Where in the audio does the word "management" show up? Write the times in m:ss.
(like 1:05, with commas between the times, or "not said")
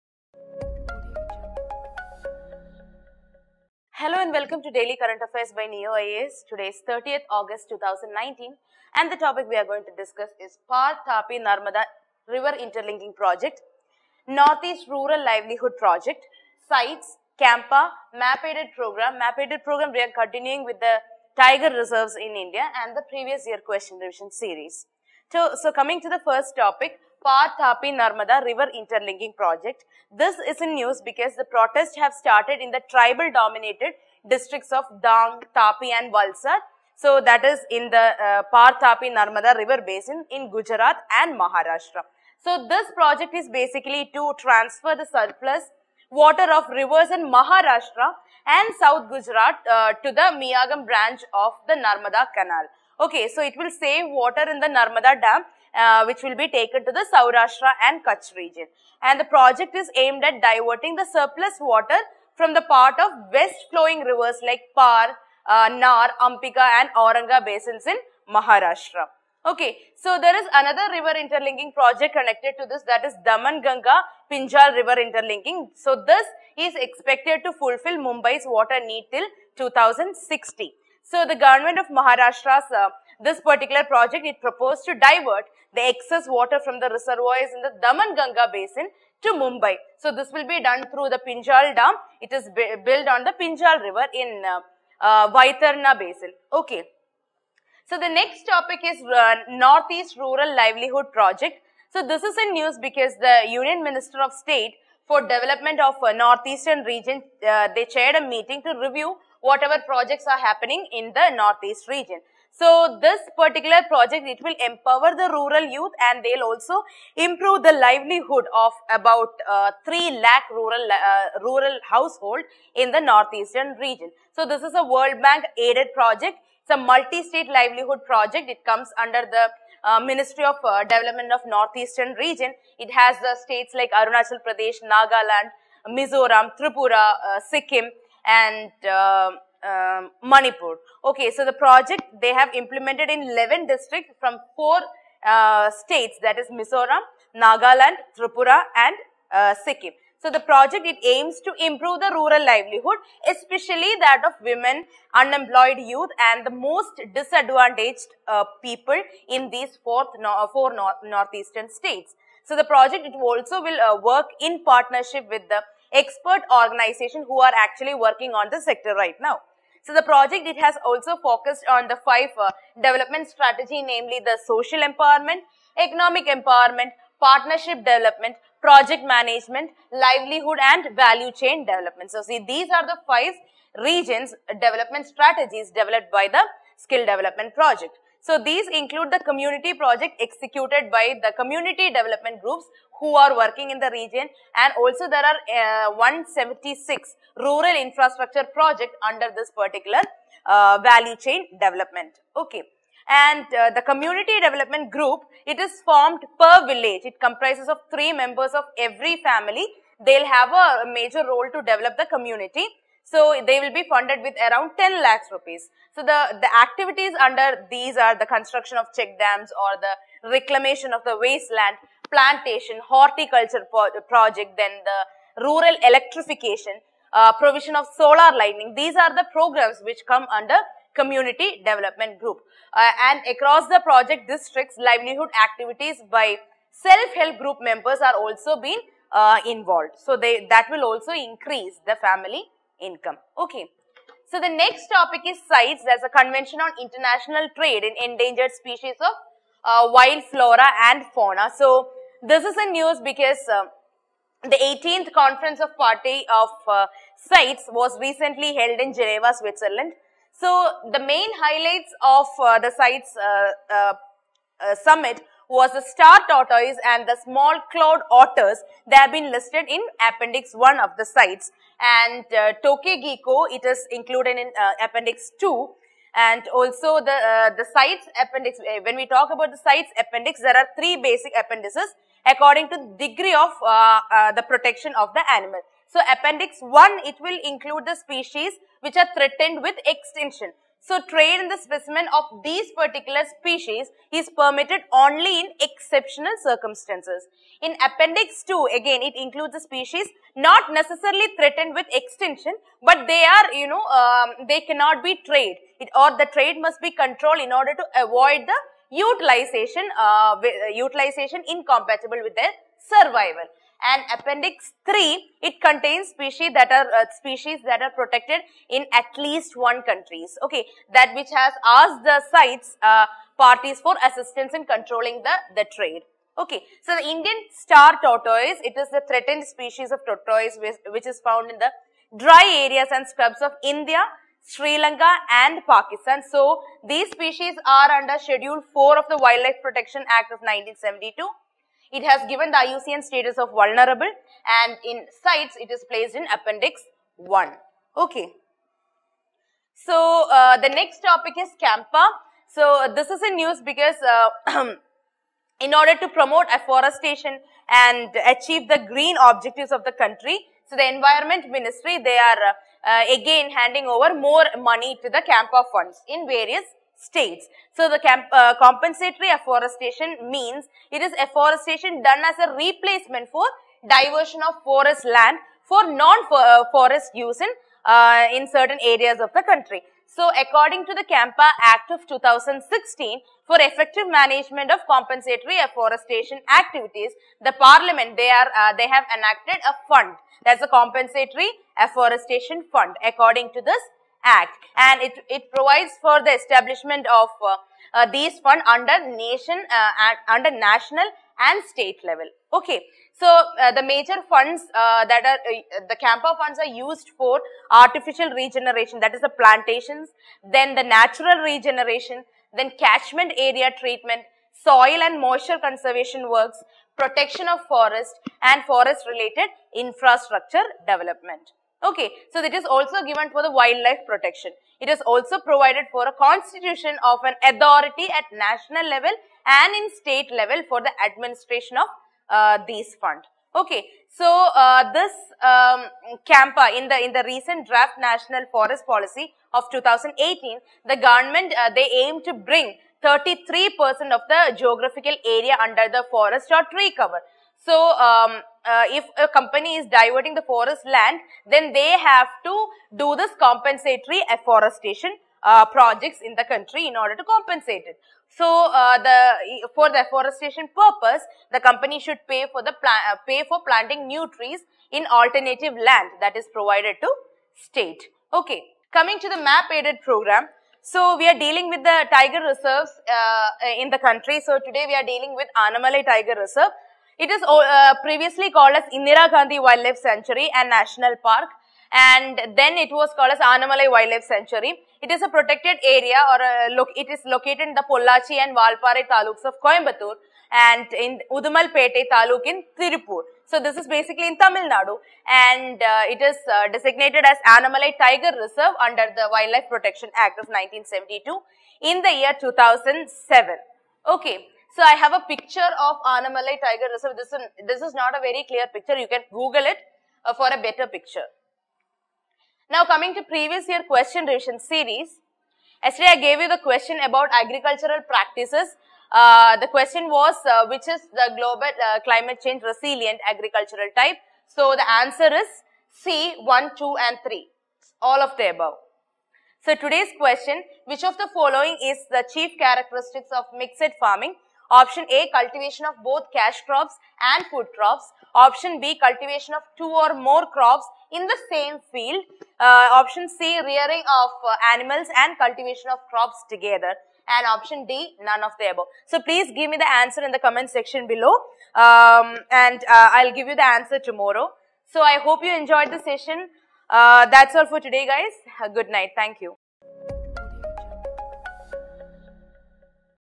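2:59, 6:24.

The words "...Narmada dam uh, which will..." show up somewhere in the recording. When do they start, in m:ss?
0:54.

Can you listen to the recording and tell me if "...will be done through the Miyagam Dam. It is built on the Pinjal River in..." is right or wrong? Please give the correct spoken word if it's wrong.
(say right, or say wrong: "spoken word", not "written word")
wrong: "Pinjal", not "Miyagam".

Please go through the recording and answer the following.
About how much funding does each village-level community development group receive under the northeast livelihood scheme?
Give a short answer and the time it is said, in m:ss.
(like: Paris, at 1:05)
10 lakh rupees, at 3:34.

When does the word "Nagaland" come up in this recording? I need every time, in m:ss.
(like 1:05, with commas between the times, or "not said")
2:14, 2:27.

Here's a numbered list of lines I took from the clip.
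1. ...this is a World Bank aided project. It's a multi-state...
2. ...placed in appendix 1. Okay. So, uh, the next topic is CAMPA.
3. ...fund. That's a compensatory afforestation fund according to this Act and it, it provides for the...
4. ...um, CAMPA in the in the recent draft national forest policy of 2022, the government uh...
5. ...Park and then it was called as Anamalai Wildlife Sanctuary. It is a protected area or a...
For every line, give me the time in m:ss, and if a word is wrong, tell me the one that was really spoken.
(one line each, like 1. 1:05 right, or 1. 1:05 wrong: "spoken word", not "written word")
1. 2:04 right
2. 5:45 right
3. 6:29 right
4. 7:15 wrong: "2018", not "2022"
5. 8:01 right.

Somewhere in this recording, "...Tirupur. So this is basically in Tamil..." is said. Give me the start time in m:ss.
8:12.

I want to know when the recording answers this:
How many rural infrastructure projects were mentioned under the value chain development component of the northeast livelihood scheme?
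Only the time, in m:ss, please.
3:15.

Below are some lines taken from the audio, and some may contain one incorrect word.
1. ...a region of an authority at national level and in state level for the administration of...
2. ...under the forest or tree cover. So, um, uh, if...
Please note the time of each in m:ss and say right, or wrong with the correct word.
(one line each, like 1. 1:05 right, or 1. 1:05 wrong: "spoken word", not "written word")
1. 7:06 wrong: "constitution", not "region"
2. 7:25 right.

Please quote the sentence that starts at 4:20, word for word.
So the main highlights of uh, the CITES uh, uh, uh, summit was the star tortoise and the small clawed otters.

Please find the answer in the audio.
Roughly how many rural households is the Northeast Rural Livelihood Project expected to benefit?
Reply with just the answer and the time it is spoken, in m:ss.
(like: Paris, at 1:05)
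3 lakh, at 1:59.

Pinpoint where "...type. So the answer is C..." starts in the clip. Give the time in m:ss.
8:43.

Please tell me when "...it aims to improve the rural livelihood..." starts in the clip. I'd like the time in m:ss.
2:30.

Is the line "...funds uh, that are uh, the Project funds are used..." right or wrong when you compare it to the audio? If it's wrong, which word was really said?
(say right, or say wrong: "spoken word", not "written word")
wrong: "CAMPA", not "Project".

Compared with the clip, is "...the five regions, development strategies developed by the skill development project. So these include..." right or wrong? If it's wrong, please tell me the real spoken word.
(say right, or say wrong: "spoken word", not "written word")
right.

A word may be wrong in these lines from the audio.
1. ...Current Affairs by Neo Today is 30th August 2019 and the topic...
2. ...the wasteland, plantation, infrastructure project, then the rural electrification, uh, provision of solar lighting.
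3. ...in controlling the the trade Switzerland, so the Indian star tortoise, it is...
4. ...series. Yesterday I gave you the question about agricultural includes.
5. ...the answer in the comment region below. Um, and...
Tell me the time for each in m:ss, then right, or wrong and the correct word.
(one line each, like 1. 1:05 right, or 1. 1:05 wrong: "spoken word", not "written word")
1. 0:04 right
2. 3:41 wrong: "horticulture", not "infrastructure"
3. 5:24 wrong: "Okay", not "Switzerland"
4. 8:34 wrong: "practices", not "includes"
5. 9:09 wrong: "section", not "region".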